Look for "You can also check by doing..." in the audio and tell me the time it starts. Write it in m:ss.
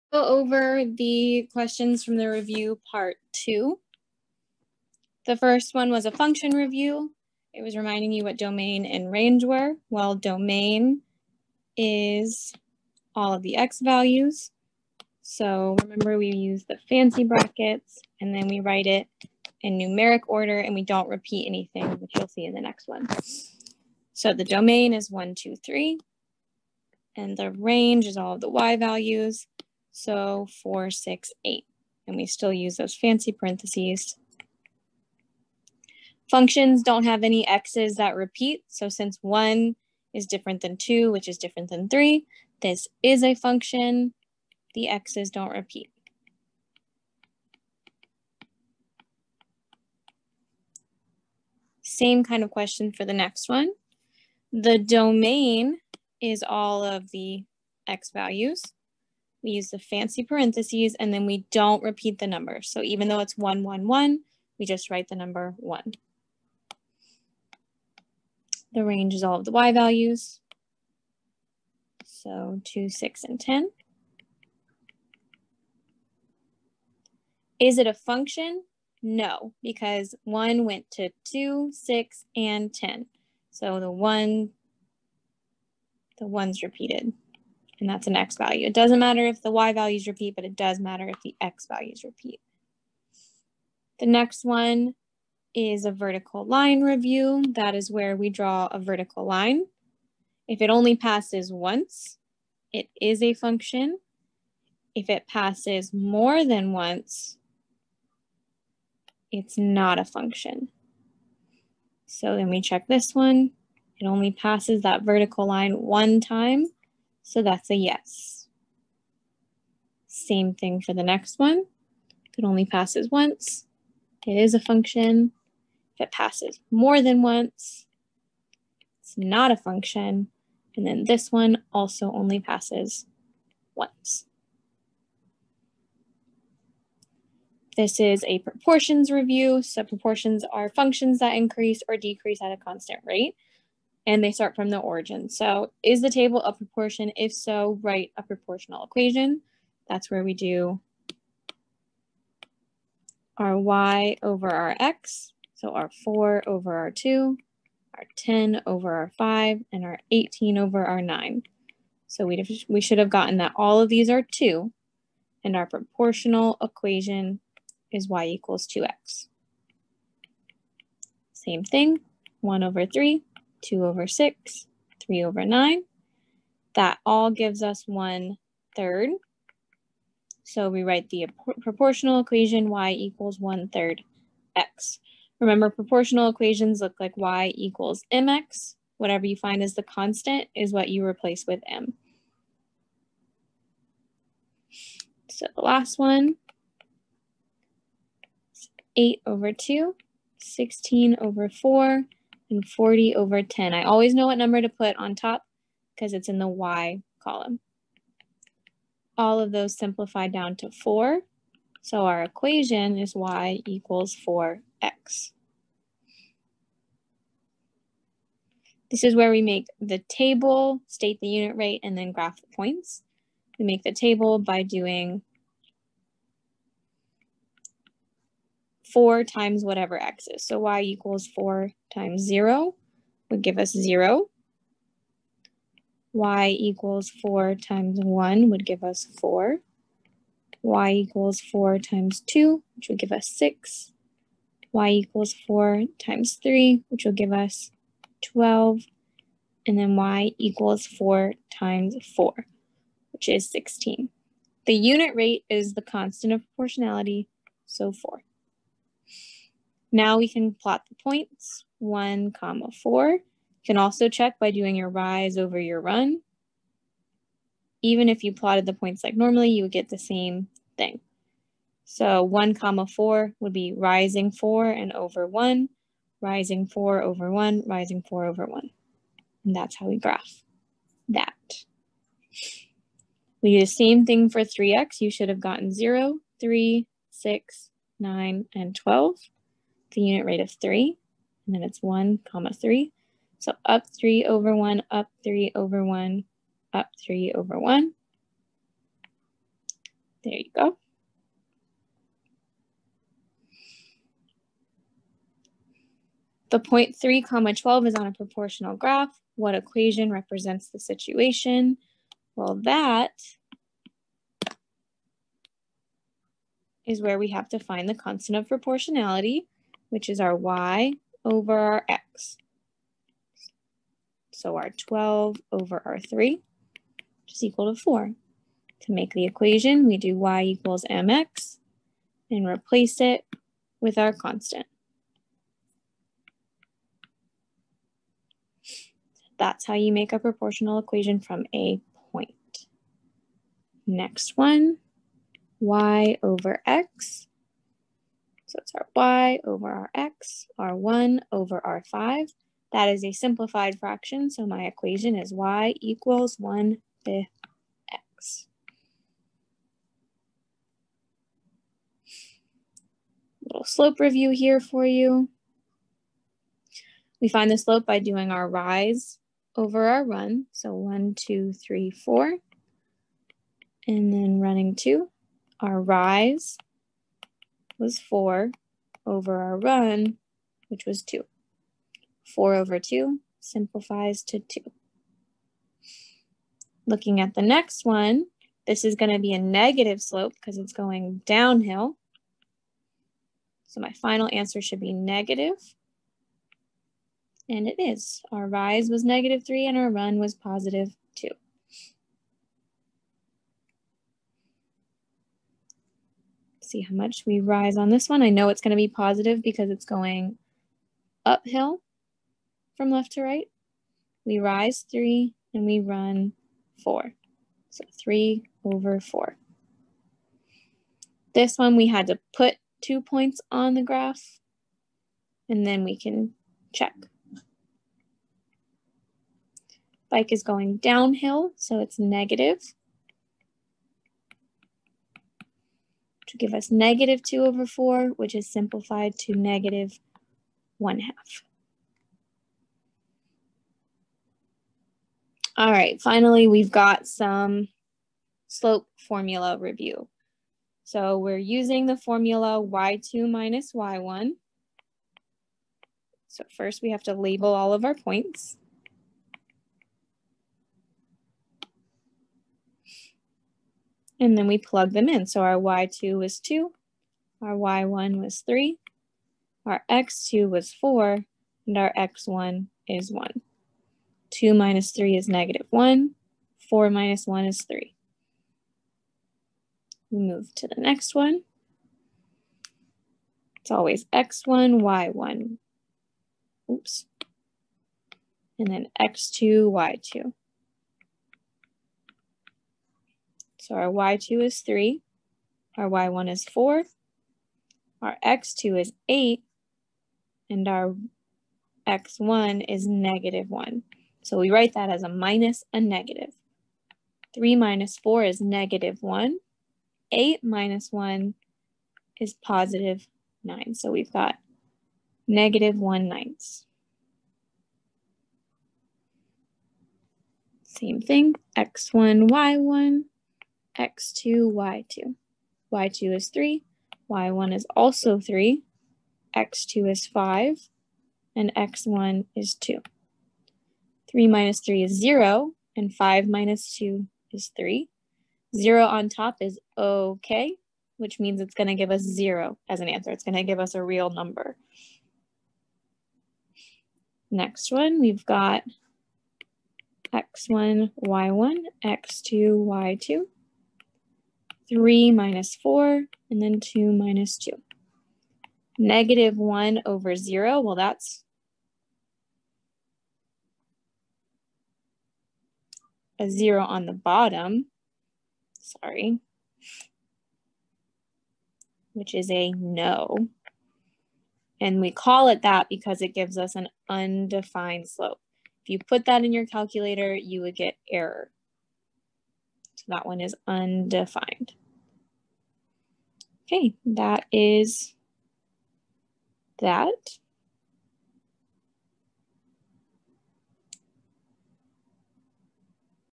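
4:23.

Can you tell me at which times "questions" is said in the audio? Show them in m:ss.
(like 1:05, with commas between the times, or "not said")
0:01, 0:52.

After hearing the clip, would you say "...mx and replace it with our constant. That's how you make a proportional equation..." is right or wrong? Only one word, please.
right.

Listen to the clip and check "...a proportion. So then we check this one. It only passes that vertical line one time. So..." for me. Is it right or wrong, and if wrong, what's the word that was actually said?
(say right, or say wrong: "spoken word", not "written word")
wrong: "function", not "proportion".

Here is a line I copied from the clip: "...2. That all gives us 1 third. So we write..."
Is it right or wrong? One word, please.
wrong.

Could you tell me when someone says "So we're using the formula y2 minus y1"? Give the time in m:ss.
7:30.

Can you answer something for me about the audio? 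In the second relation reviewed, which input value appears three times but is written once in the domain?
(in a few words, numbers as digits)
1.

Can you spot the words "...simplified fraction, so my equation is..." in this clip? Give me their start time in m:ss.
5:53.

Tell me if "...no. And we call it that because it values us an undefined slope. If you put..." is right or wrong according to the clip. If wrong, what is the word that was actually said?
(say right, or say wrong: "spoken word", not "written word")
wrong: "gives", not "values".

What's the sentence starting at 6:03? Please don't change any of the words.
Little slope review here for you.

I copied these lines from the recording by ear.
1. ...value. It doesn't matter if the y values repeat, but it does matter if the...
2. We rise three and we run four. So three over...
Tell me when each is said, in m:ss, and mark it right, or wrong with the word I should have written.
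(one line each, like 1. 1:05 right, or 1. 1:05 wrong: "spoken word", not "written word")
1. 1:28 right
2. 6:54 right.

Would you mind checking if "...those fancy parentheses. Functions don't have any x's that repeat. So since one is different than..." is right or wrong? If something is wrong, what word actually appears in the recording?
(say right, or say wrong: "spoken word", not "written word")
right.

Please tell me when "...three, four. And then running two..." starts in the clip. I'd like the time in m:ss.
6:11.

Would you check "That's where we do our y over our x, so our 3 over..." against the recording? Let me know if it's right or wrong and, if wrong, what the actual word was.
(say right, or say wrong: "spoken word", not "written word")
wrong: "4", not "3".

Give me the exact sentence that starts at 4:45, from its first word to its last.
You should have gotten 0, 3, 6, 9, and 12 the unit rate of 3, and then it's 1 comma 3.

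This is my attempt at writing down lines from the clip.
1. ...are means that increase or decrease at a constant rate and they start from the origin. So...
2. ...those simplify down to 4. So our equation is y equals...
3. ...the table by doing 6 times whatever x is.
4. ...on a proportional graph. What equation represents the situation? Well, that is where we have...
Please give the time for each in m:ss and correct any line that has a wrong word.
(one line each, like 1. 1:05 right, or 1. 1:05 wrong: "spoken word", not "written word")
1. 2:20 wrong: "functions", not "means"
2. 3:29 right
3. 3:43 wrong: "4", not "6"
4. 5:07 right.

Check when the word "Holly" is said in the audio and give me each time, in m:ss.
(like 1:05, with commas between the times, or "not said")
not said.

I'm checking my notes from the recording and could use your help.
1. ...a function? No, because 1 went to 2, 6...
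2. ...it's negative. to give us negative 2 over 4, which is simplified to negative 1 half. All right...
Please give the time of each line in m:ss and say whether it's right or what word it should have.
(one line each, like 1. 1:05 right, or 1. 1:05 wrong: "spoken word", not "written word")
1. 1:17 right
2. 7:11 right.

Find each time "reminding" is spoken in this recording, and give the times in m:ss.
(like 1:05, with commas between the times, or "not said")
0:07.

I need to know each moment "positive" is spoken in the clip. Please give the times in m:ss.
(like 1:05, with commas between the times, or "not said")
6:40, 6:48, 8:32.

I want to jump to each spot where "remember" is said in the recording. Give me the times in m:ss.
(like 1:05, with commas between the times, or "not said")
0:15, 3:05.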